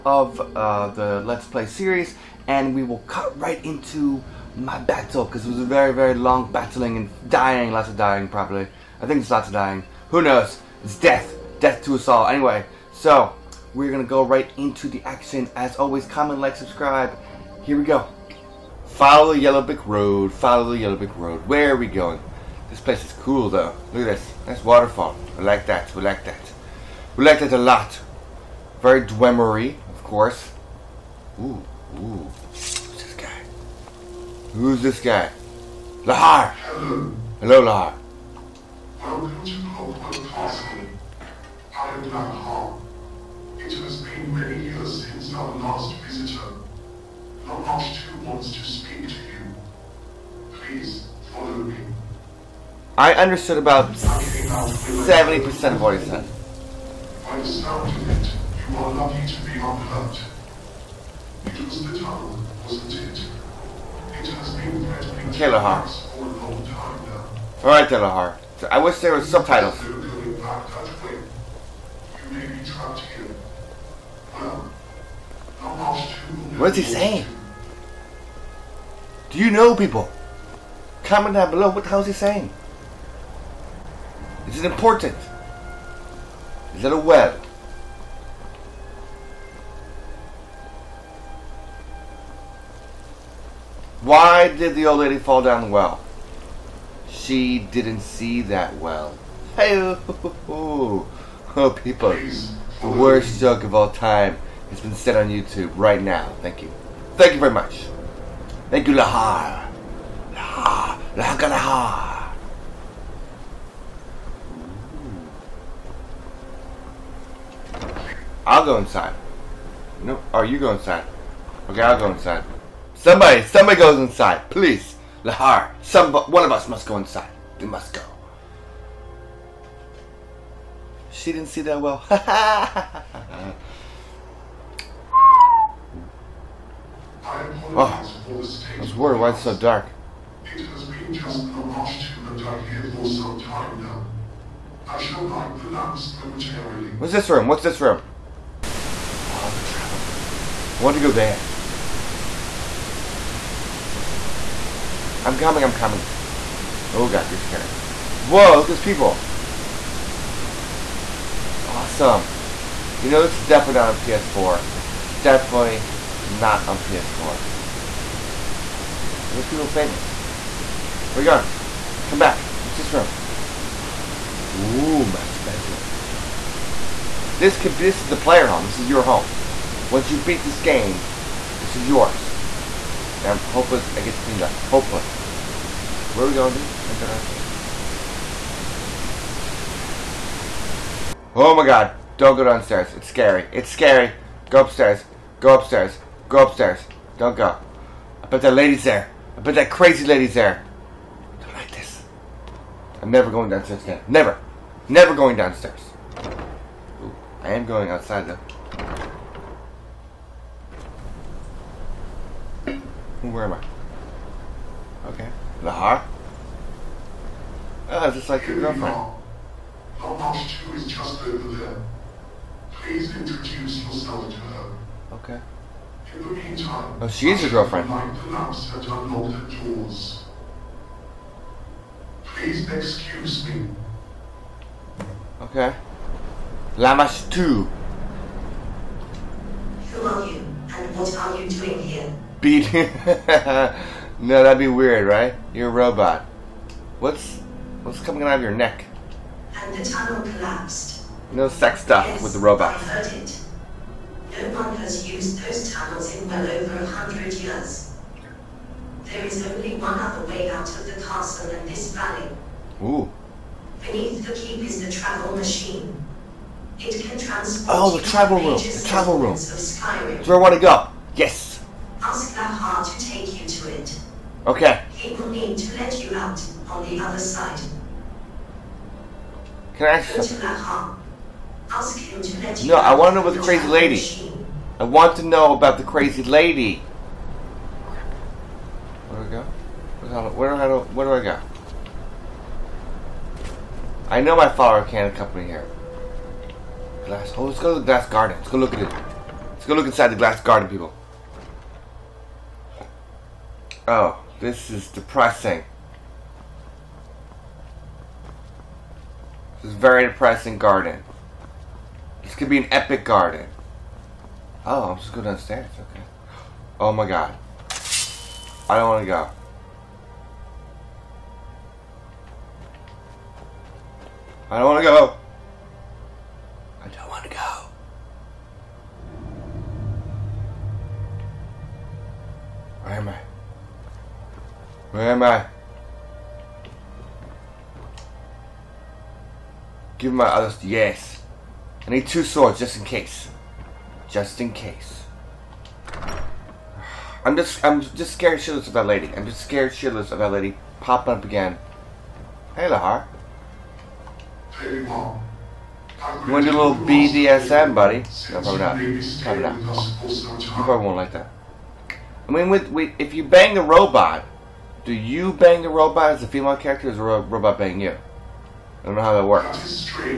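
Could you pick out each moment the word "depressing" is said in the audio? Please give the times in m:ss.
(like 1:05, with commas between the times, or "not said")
5:04, 5:10.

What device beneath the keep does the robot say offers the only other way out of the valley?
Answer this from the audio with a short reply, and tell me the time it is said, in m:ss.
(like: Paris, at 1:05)
travel machine, at 4:24.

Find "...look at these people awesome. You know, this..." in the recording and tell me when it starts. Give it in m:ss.
2:38.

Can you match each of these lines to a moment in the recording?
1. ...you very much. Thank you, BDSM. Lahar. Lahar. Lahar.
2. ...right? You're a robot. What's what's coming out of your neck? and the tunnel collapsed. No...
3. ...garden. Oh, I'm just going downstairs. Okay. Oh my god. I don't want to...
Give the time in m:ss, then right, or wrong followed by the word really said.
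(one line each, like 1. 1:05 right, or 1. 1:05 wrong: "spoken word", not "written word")
1. 1:47 wrong: "Lahar", not "BDSM"
2. 4:05 right
3. 5:13 right.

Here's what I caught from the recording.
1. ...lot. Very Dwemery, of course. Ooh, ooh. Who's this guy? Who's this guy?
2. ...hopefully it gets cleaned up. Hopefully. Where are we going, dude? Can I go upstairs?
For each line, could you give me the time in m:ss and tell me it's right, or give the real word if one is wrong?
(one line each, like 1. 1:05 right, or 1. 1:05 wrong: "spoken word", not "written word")
1. 0:27 right
2. 3:03 wrong: "downstairs", not "upstairs".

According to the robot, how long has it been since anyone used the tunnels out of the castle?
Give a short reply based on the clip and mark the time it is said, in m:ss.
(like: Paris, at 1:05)
over a hundred years, at 4:16.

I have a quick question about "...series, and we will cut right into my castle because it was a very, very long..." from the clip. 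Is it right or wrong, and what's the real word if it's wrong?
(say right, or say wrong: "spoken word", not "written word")
wrong: "battle", not "castle".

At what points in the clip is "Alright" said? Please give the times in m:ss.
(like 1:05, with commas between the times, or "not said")
1:07.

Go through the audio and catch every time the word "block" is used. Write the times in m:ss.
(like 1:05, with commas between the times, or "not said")
not said.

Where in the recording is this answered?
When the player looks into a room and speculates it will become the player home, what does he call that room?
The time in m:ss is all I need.
2:55.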